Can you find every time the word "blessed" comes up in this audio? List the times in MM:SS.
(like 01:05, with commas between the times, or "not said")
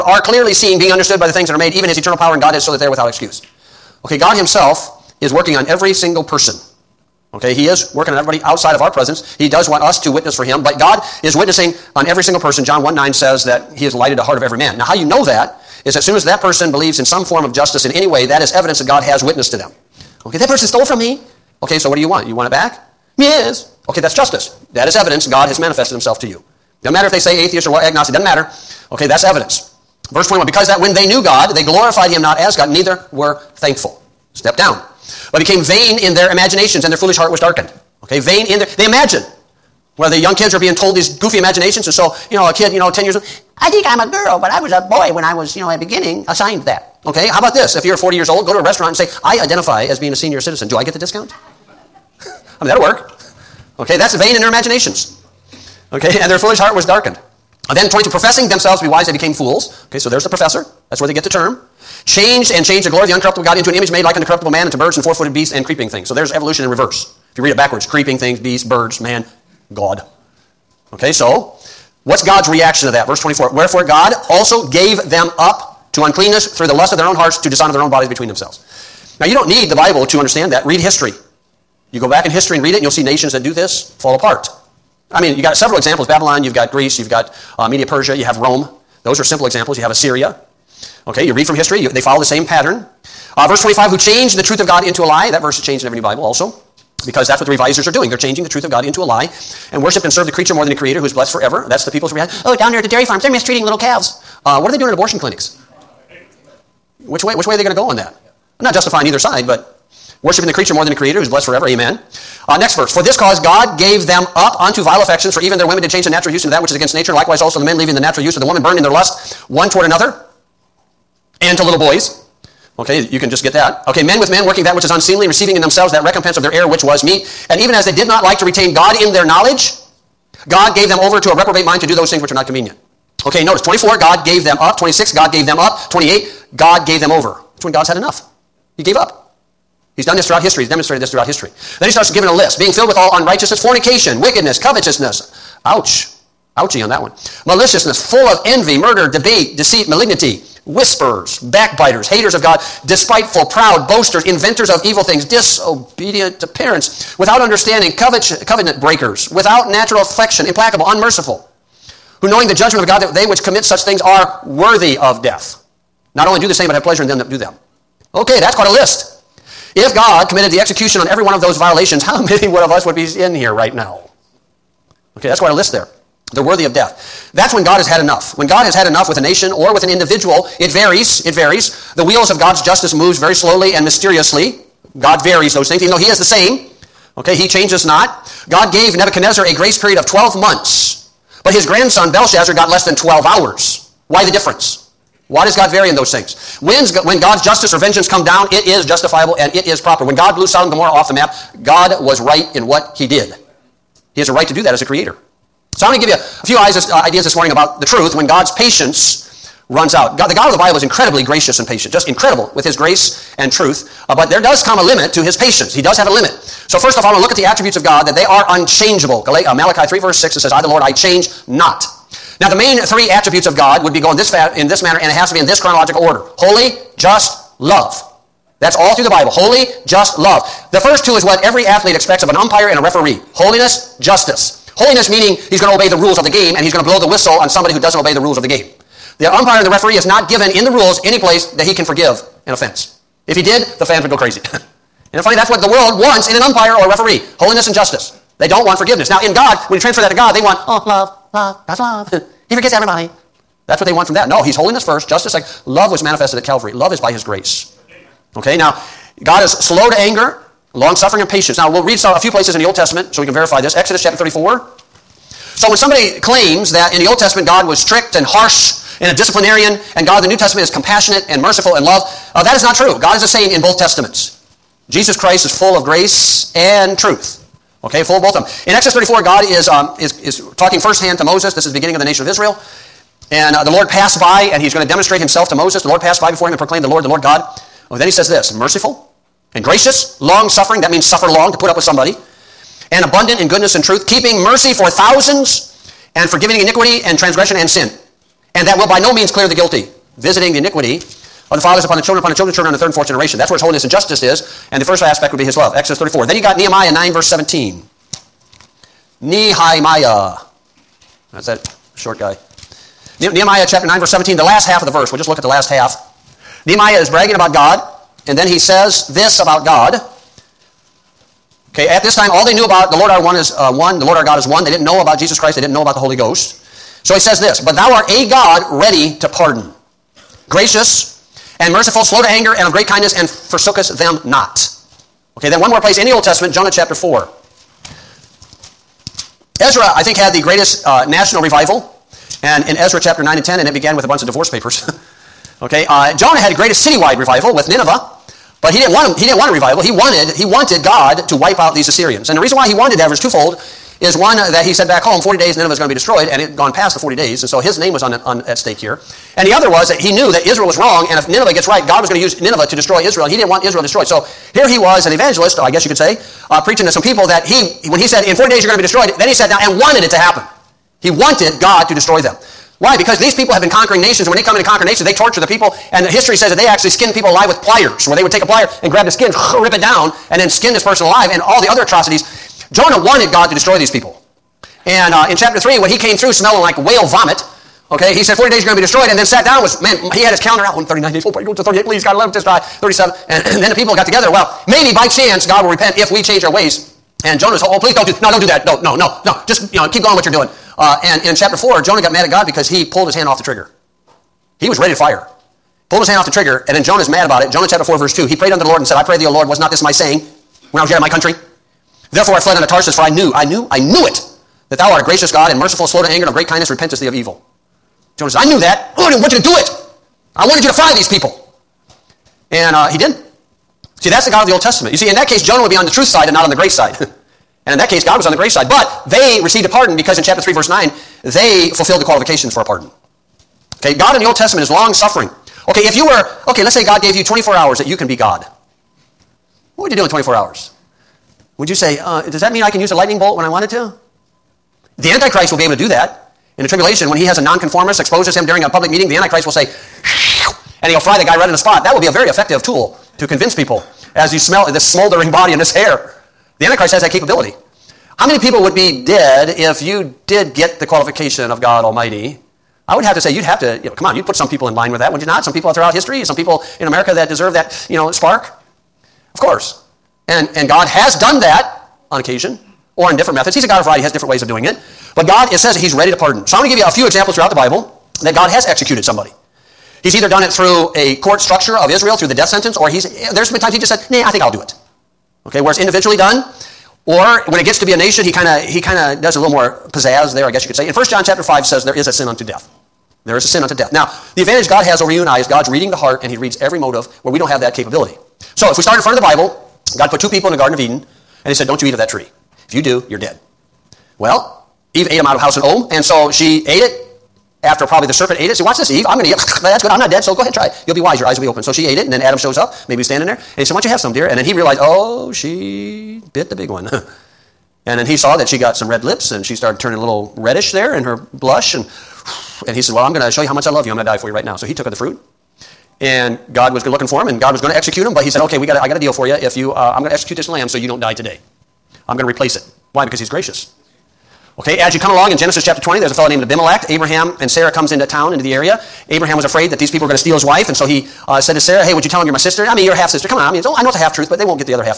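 01:41, 01:51.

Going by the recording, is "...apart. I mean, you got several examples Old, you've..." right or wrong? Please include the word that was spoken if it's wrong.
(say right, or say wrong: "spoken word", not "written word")
wrong: "Babylon", not "Old".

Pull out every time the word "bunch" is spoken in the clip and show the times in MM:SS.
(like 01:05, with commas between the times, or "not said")
05:44.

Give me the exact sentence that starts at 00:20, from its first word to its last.
Okay, that person stole from me.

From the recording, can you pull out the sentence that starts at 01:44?
Uh, what are they doing at abortion clinics?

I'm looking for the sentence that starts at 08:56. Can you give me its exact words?
Abraham and Sarah comes into town, into the area.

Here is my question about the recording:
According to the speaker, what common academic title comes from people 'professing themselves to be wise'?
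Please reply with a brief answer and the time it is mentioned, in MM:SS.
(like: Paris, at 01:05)
professor, at 01:00.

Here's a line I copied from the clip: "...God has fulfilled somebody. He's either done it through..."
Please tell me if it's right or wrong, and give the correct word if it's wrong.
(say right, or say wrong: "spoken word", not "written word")
wrong: "executed", not "fulfilled".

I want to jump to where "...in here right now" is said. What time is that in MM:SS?
02:53.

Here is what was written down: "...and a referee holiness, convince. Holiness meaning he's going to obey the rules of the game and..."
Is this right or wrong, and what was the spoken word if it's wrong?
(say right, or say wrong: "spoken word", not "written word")
wrong: "justice", not "convince".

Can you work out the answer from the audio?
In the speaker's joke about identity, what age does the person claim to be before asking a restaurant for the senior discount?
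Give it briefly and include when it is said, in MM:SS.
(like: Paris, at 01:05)
40, at 00:47.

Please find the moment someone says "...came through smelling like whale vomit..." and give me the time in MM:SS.
06:25.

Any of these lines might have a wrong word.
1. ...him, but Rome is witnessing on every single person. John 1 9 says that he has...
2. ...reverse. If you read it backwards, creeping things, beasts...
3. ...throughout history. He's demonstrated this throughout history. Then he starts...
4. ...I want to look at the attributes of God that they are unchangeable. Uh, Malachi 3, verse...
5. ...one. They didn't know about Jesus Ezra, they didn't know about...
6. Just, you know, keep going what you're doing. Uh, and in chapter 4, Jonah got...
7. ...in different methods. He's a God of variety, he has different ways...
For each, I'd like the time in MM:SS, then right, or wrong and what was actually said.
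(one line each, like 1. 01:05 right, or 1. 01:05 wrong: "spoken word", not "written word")
1. 00:10 wrong: "God", not "Rome"
2. 01:06 right
3. 02:20 right
4. 03:37 right
5. 05:24 wrong: "Christ", not "Ezra"
6. 06:39 right
7. 07:53 right.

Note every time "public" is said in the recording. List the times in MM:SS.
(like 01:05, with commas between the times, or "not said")
07:28.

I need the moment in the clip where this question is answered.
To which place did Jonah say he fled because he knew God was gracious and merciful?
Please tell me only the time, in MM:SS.
06:52.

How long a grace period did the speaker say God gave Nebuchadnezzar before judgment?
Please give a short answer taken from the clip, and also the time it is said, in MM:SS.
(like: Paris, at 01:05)
12 months, at 03:10.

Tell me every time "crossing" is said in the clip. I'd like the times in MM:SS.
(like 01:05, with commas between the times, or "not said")
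not said.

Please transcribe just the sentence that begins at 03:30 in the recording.
God, the God of the Bible is incredibly gracious and patient, just incredible with his grace and truth.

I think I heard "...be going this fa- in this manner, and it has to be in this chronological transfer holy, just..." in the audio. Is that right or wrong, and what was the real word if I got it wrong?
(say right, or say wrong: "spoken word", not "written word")
wrong: "order", not "transfer".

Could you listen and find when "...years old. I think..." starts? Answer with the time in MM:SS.
00:43.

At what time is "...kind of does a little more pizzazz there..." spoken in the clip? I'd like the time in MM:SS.
08:08.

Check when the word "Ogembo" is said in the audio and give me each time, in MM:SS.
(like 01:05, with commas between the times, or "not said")
not said.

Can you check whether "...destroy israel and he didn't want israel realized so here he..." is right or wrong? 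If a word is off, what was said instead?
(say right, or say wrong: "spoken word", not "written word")
wrong: "destroyed", not "realized".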